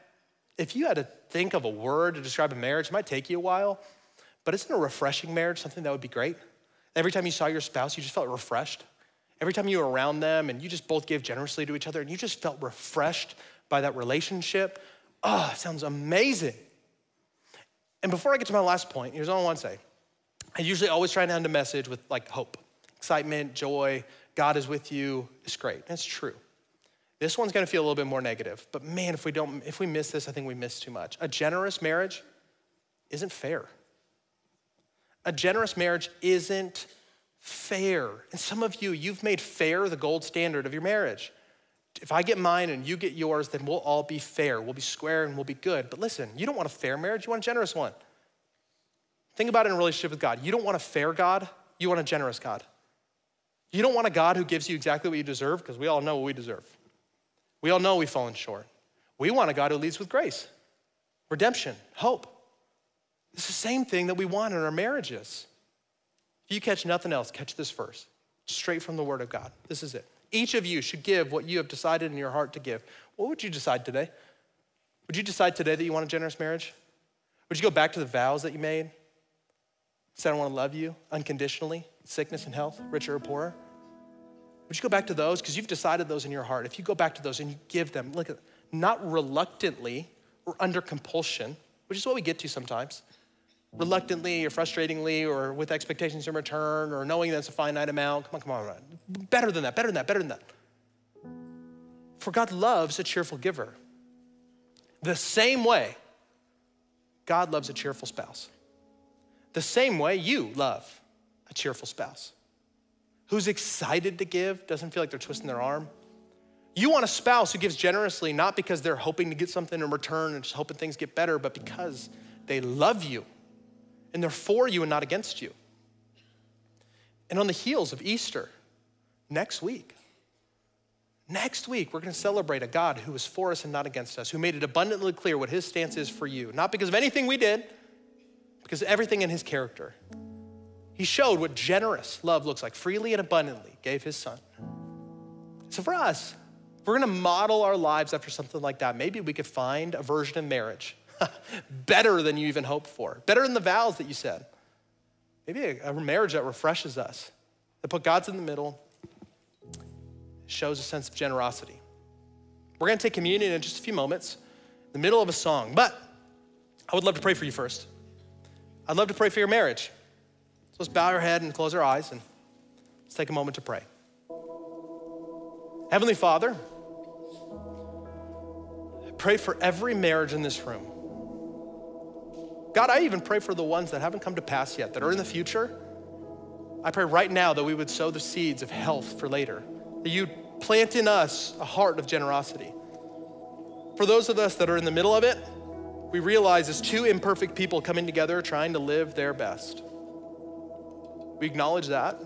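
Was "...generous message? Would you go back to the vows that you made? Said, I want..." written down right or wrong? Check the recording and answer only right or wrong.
wrong.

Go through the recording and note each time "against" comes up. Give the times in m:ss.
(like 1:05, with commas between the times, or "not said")
2:05, 2:13.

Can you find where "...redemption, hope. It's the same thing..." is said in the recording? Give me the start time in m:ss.
1:01.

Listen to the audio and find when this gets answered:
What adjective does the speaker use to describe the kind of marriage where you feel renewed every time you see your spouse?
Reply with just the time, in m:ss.
0:04.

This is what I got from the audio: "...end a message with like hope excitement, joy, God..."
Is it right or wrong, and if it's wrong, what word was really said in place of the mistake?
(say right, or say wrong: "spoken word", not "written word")
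right.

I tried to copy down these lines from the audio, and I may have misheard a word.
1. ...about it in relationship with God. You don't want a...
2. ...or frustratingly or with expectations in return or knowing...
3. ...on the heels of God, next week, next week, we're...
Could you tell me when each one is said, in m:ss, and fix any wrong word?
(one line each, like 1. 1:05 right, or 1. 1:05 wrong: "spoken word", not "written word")
1. 0:49 right
2. 1:34 right
3. 2:07 wrong: "Easter", not "God".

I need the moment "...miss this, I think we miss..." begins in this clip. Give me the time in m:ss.
0:29.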